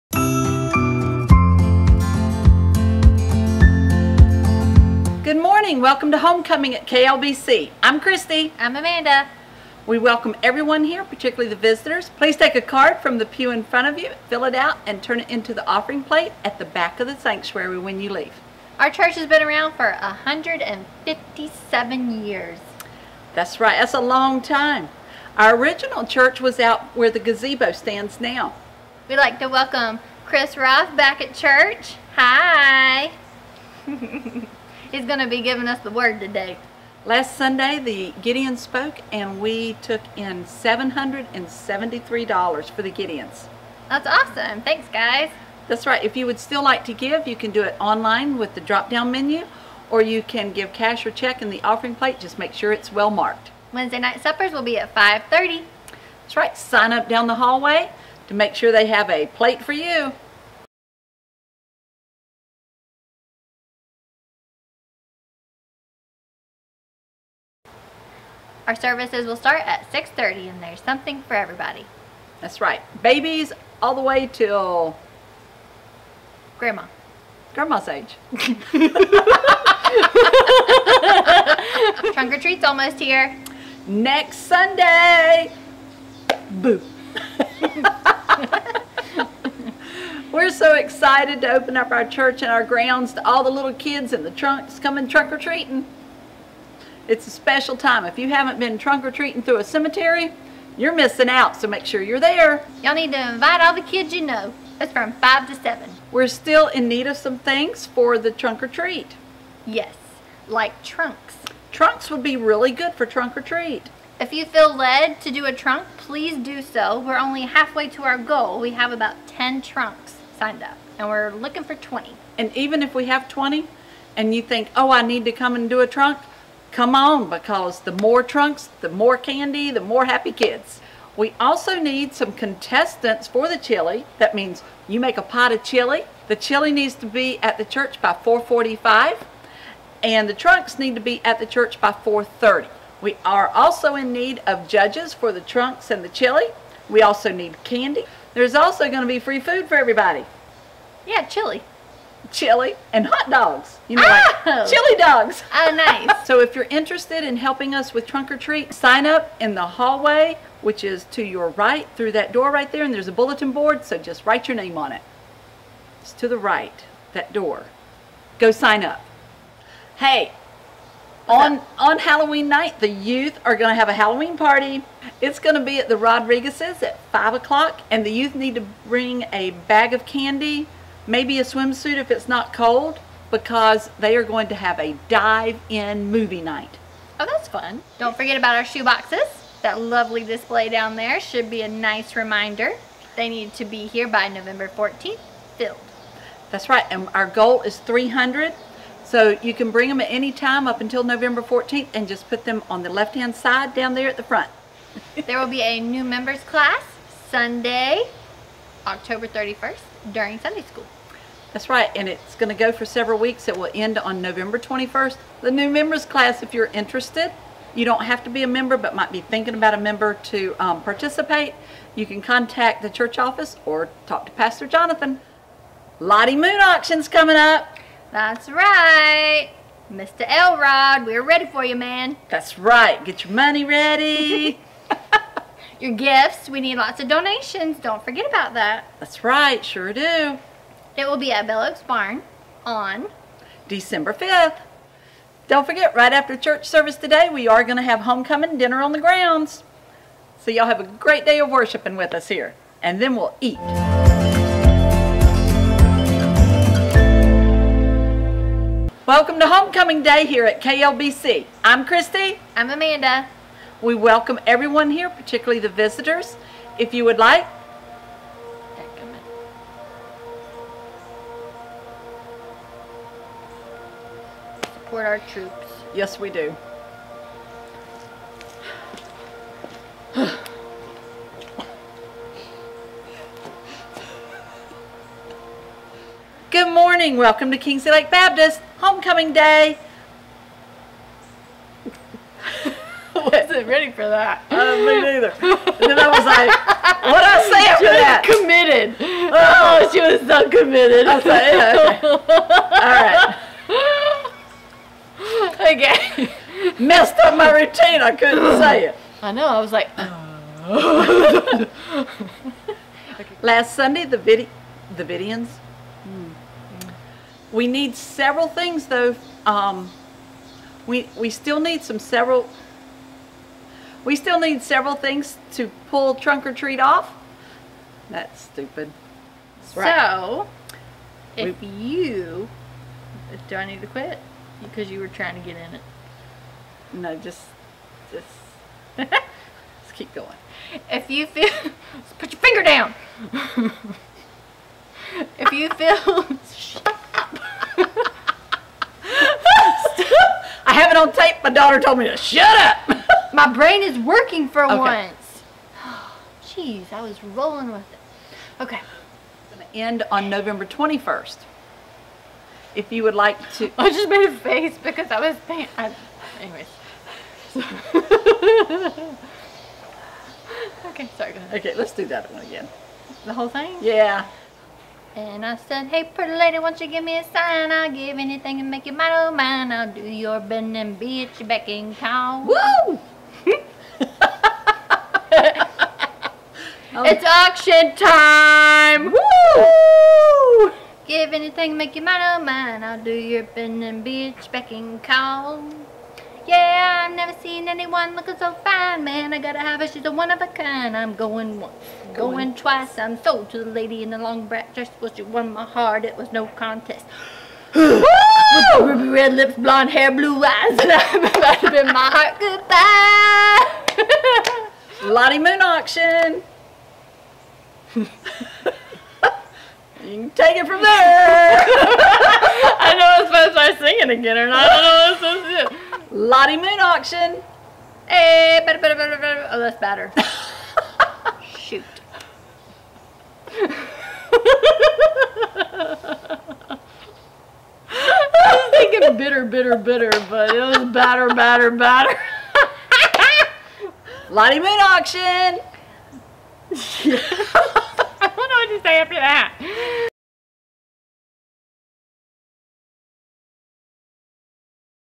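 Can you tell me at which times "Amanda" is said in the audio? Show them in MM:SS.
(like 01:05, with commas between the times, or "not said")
00:08, 04:22.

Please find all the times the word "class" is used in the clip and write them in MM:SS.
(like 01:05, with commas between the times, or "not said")
03:26, 03:36.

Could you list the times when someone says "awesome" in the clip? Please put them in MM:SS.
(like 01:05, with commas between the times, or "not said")
00:44.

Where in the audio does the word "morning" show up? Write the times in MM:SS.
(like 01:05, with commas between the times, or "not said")
00:05, 04:46.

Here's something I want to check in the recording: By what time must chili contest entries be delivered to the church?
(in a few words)
4:45.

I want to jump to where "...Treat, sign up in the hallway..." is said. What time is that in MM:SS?
02:38.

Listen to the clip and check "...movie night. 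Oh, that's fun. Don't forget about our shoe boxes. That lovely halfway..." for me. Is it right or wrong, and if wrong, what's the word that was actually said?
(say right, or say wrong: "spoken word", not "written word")
wrong: "display", not "halfway".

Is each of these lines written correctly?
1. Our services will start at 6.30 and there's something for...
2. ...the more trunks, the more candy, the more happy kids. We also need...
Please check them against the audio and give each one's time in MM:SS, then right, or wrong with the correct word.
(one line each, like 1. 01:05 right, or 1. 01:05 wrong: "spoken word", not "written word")
1. 01:08 right
2. 02:07 right.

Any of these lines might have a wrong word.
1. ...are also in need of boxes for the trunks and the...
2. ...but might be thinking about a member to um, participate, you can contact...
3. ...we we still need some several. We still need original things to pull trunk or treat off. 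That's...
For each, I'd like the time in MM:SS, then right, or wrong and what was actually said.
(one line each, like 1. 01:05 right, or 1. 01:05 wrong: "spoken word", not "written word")
1. 02:23 wrong: "judges", not "boxes"
2. 03:38 right
3. 05:20 wrong: "several", not "original".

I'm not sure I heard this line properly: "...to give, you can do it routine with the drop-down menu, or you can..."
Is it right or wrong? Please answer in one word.
wrong.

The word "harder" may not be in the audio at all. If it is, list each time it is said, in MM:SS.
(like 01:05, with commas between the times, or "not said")
not said.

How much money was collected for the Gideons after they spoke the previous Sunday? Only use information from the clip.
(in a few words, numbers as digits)
$773.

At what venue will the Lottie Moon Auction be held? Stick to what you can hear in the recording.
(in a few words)
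Bell Oaks Barn.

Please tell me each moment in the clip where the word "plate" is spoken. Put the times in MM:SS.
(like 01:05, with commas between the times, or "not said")
00:16, 00:51, 00:59.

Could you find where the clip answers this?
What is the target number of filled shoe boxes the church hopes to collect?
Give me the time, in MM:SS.
03:17.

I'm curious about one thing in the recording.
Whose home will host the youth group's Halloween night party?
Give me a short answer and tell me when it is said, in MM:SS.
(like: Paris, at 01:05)
the Rodriguez's, at 02:55.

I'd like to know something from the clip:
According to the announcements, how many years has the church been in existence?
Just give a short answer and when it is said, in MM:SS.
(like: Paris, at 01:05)
157 years, at 00:20.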